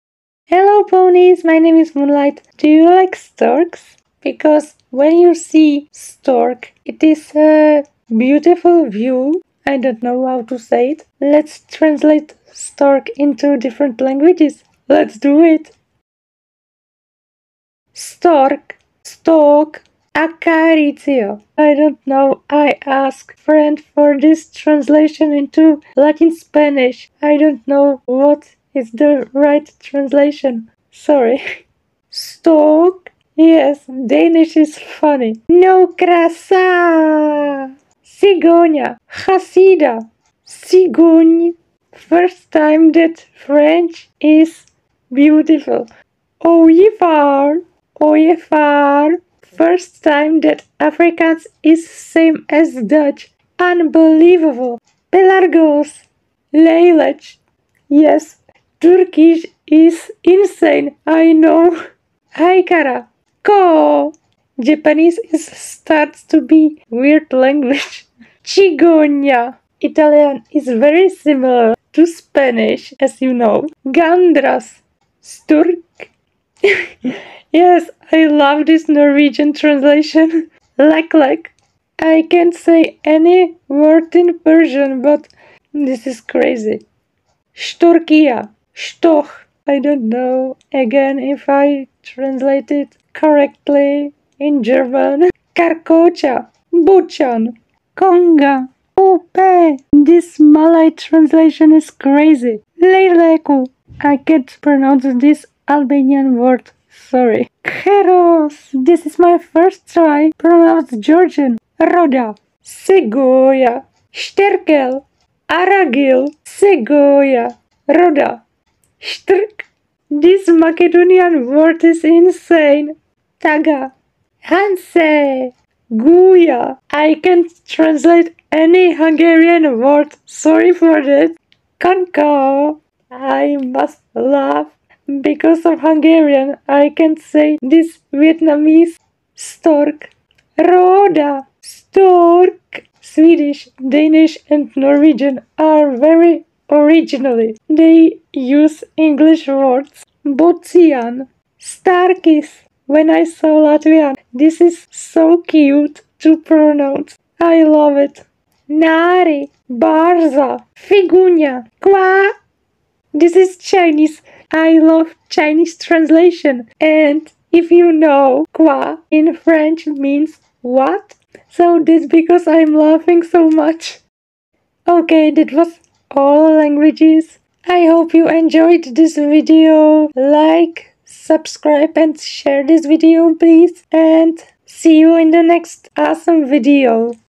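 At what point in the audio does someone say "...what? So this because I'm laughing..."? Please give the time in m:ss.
2:50.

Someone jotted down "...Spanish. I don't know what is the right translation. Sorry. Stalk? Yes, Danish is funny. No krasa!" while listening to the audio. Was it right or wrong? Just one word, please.
right.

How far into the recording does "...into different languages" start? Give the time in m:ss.
0:13.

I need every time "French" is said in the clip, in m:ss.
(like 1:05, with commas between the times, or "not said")
0:43, 2:49.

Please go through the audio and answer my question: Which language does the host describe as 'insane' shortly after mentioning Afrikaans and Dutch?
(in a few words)
Turkish.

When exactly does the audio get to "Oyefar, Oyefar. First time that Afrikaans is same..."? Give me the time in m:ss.
0:46.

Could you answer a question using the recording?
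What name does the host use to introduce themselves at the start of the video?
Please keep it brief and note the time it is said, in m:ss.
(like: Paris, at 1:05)
Moonlight, at 0:01.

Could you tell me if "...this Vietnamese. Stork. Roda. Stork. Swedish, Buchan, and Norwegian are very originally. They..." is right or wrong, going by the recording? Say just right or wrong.
wrong.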